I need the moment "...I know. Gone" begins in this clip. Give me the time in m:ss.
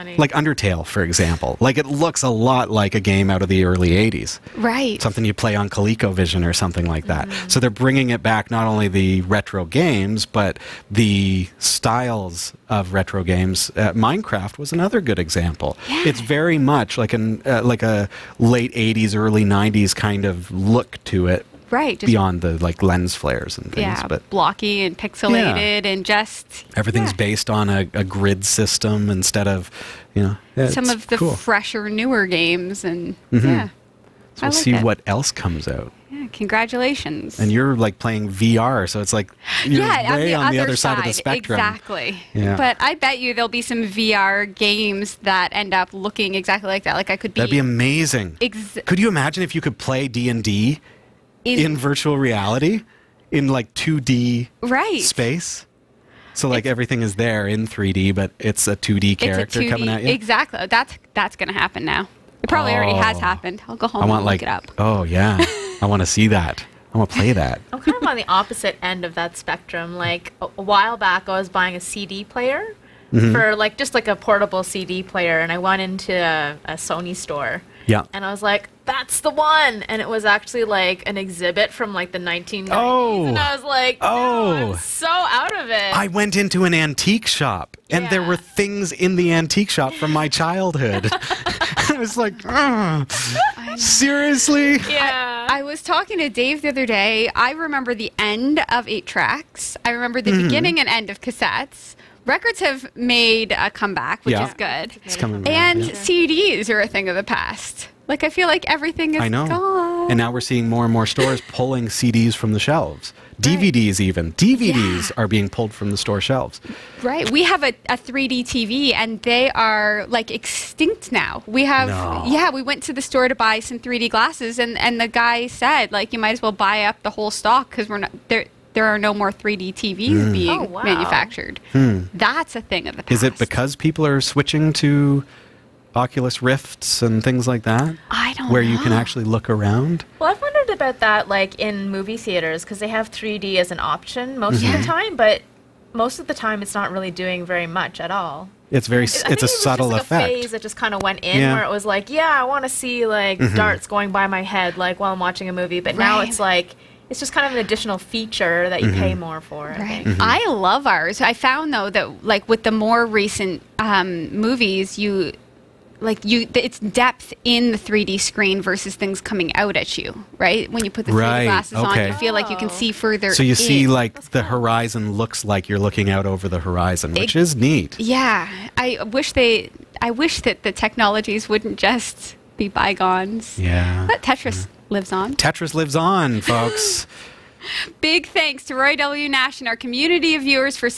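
1:49.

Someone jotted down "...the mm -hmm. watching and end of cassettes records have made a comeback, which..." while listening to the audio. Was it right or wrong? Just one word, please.
wrong.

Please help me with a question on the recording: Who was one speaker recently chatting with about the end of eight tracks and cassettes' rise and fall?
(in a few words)
Dave.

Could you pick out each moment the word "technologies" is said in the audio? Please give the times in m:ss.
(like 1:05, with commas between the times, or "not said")
3:00.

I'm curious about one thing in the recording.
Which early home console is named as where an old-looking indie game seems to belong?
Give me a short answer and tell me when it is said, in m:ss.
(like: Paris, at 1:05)
ColecoVision, at 0:05.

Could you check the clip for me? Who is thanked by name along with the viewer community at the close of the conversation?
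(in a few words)
Roy W. Nash.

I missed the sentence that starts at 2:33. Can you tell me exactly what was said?
darts going by my head like while I'm watching a movie, but right.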